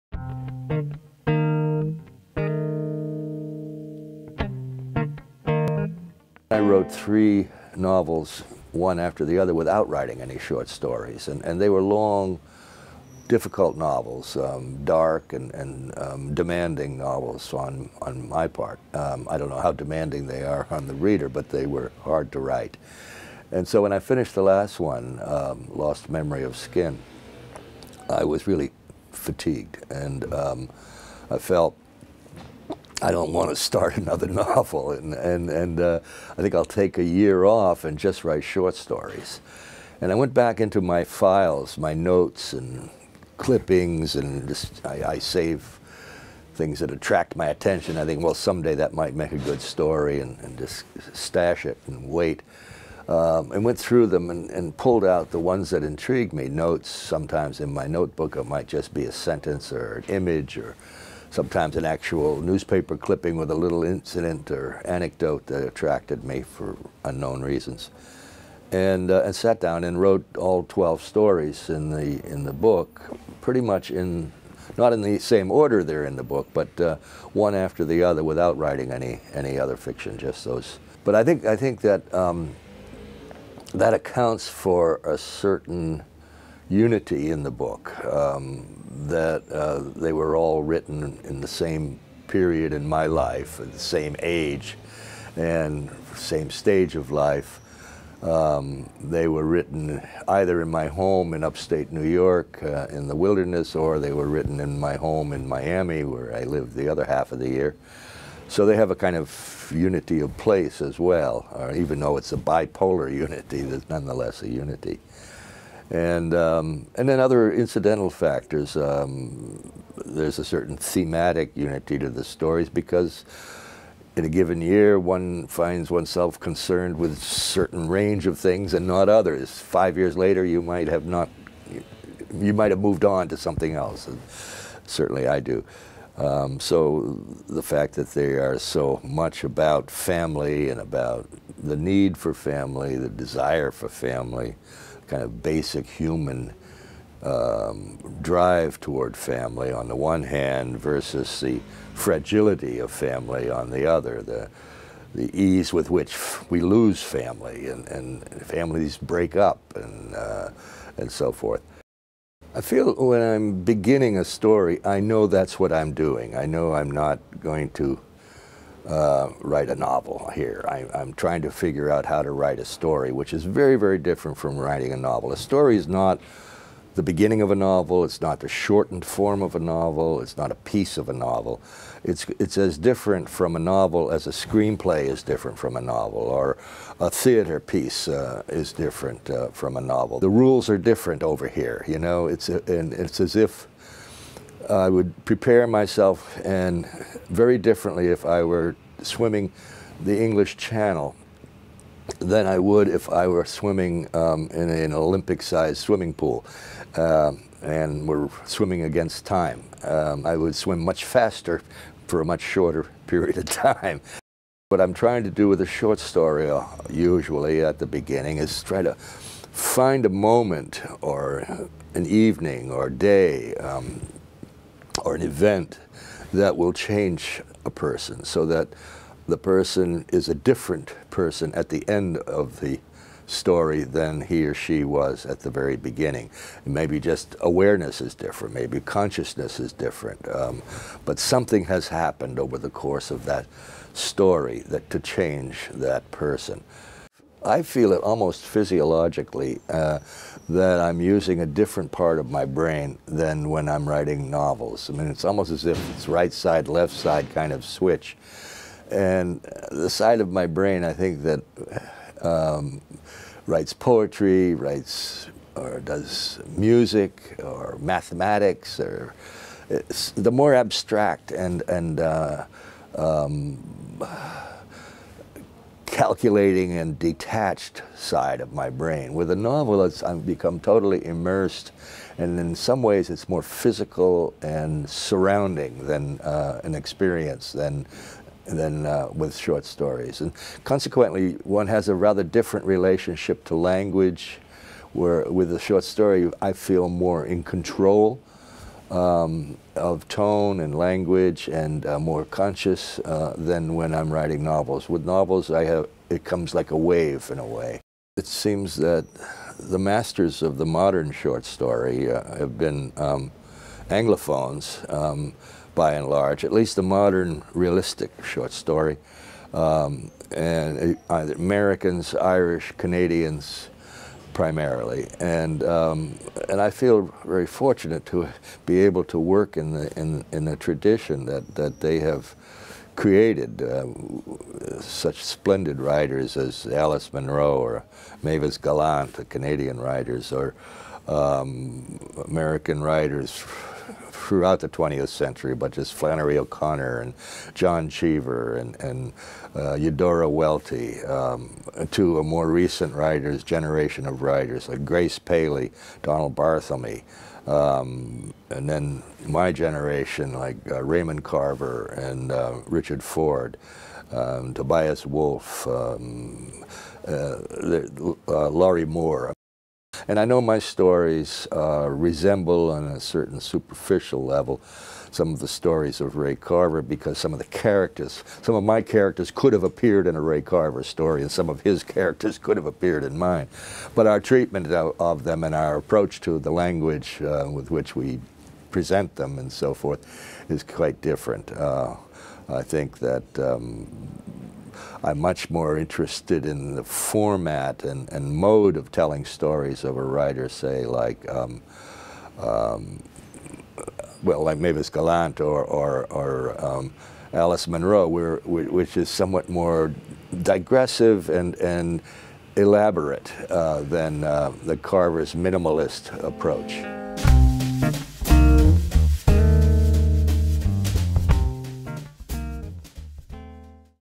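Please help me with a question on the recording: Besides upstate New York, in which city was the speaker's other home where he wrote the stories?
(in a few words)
Miami.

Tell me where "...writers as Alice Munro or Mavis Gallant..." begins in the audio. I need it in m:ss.
5:35.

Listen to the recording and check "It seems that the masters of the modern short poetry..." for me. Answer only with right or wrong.
wrong.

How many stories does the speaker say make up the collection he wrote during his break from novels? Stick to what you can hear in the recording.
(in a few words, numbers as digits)
12.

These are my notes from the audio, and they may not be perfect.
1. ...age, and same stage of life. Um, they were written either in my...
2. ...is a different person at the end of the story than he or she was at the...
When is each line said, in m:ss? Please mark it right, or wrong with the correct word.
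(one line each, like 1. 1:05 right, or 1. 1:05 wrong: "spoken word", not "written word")
1. 1:34 right
2. 3:50 right.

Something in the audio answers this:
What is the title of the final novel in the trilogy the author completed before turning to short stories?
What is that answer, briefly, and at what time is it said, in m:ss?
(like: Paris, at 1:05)
Lost Memory of Skin, at 0:25.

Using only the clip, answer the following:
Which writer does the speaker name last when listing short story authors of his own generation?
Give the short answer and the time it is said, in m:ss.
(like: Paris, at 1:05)
Lorrie Moore, at 6:08.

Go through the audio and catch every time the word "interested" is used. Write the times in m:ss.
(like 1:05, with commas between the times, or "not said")
6:35.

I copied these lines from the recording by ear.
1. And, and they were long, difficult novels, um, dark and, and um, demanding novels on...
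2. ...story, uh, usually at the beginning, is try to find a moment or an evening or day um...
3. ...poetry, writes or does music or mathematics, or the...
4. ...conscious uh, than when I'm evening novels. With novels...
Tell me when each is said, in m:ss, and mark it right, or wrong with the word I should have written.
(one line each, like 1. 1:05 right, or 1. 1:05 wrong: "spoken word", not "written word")
1. 0:11 right
2. 3:35 right
3. 4:23 right
4. 5:02 wrong: "writing", not "evening".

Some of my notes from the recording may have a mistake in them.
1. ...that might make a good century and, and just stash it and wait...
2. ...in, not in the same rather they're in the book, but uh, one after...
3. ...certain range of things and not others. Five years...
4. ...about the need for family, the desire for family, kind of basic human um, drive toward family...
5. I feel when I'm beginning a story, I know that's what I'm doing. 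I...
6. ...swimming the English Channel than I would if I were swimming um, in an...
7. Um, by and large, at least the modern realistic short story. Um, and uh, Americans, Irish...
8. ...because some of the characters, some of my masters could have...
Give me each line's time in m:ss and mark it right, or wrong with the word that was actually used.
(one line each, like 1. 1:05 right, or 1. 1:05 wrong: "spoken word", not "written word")
1. 0:48 wrong: "story", not "century"
2. 1:13 wrong: "order", not "rather"
3. 2:07 right
4. 2:20 right
5. 2:42 right
6. 3:19 right
7. 5:14 right
8. 6:16 wrong: "characters", not "masters".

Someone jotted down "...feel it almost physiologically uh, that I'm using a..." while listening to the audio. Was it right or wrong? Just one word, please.
right.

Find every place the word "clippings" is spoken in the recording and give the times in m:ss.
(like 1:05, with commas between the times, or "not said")
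0:43, 1:02.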